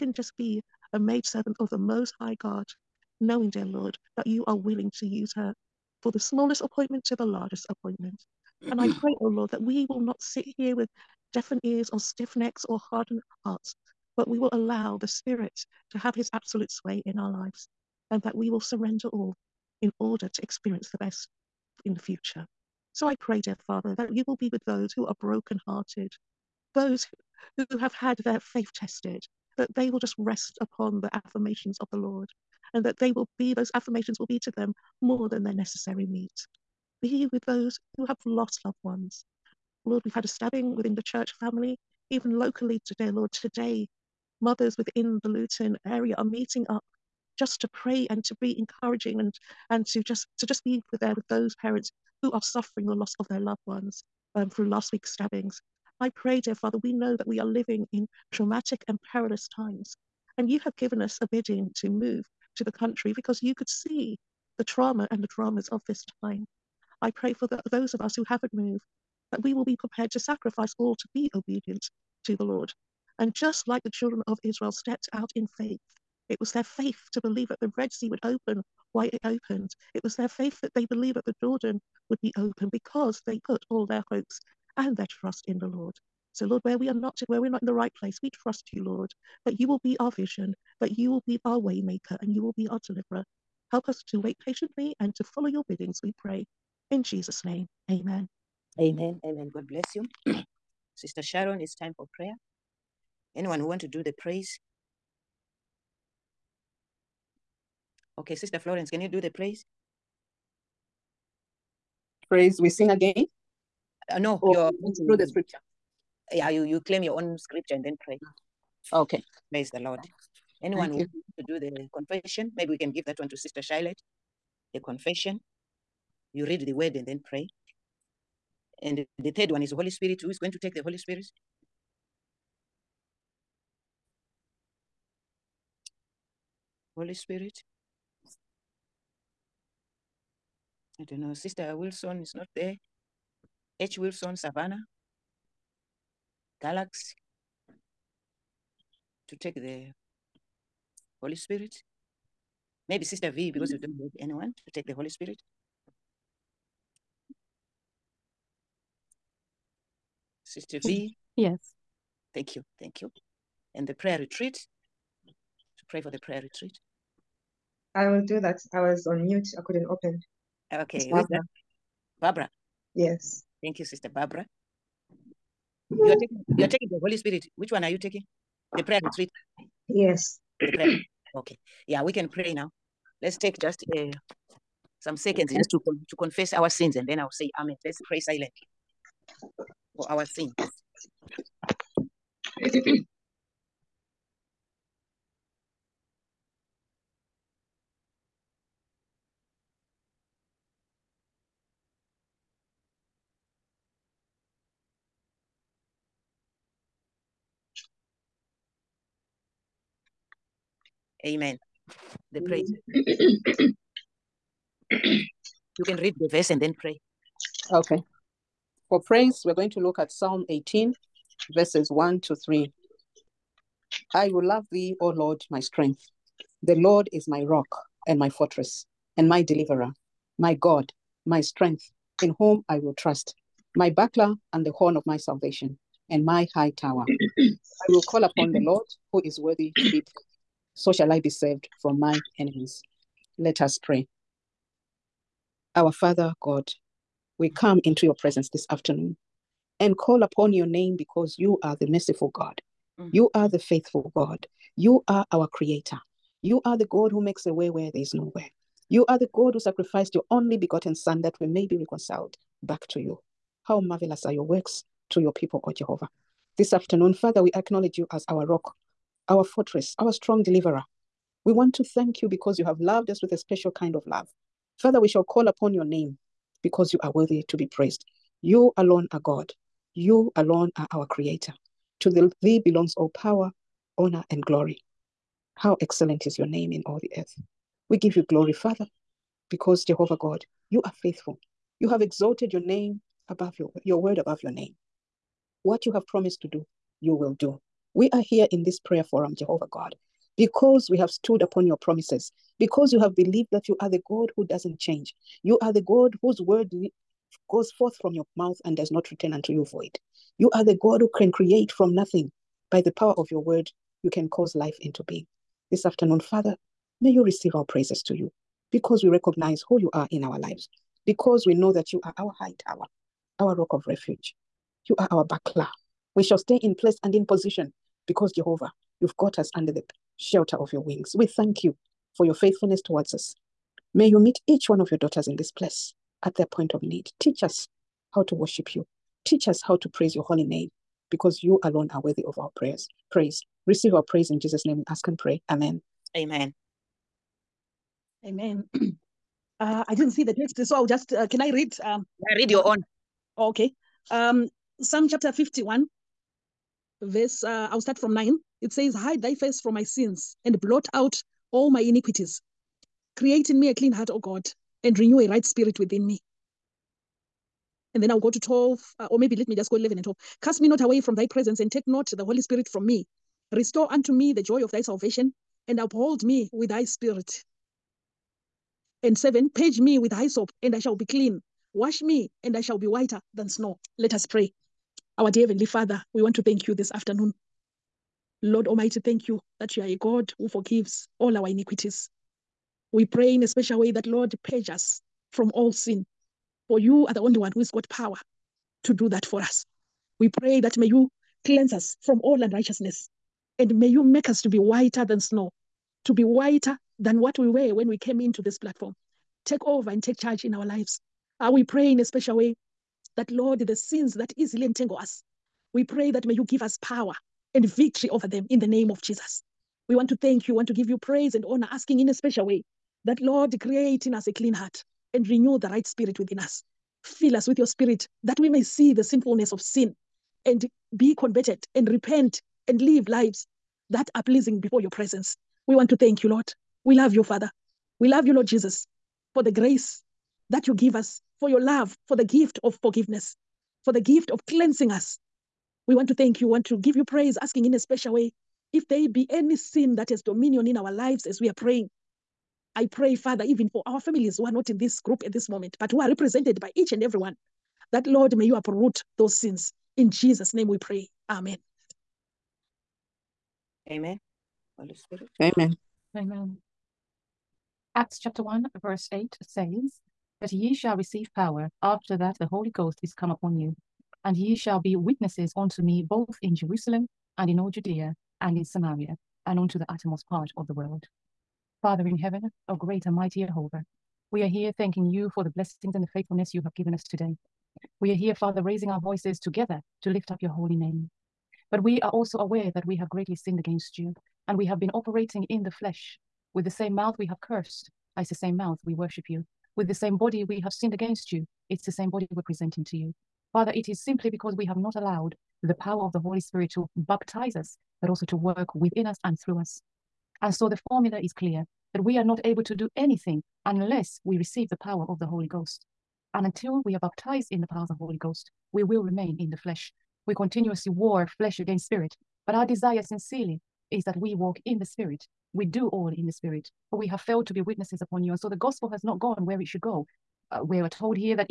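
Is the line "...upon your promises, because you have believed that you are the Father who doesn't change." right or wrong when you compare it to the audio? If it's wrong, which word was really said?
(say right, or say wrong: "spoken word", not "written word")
wrong: "God", not "Father".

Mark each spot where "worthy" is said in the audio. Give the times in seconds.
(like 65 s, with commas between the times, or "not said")
239 s, 277 s, 342 s.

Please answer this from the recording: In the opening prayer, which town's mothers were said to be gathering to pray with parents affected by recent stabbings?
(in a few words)
Luton.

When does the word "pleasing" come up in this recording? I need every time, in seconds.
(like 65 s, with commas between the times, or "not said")
434 s.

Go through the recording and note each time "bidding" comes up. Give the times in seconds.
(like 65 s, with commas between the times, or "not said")
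61 s, 95 s.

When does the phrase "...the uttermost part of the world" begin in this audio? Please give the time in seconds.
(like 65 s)
479 s.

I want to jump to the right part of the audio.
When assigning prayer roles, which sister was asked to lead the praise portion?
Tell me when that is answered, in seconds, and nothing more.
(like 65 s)
108 s.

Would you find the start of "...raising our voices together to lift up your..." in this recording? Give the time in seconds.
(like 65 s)
488 s.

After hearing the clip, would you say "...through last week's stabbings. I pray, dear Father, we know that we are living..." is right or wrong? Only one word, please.
right.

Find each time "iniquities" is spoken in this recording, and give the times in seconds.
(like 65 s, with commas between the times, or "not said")
361 s, 391 s.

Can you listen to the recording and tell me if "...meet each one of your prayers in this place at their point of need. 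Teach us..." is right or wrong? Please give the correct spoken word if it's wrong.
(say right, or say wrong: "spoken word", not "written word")
wrong: "daughters", not "prayers".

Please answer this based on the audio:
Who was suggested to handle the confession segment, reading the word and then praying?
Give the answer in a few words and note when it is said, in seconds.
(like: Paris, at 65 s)
Sister Charlotte, at 123 s.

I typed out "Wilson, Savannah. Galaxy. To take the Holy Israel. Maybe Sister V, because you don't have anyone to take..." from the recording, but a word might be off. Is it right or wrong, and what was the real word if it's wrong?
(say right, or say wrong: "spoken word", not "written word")
wrong: "Spirit", not "Israel".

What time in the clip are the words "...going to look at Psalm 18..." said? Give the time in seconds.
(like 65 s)
219 s.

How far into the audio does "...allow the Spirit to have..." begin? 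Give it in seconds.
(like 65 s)
14 s.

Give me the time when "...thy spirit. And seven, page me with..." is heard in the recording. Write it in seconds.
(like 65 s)
376 s.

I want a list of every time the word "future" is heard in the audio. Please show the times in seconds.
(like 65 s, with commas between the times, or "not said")
21 s.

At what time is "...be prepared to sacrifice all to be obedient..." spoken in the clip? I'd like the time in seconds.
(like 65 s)
69 s.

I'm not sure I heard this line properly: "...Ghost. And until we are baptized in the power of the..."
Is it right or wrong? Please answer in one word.
right.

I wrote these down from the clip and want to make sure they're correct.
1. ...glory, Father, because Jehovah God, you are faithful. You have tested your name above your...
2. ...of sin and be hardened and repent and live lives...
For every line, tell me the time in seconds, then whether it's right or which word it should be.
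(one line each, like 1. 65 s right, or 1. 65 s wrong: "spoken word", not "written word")
1. 288 s wrong: "exalted", not "tested"
2. 429 s wrong: "converted", not "hardened".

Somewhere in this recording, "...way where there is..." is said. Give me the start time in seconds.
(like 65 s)
257 s.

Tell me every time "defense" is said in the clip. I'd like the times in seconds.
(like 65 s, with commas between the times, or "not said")
not said.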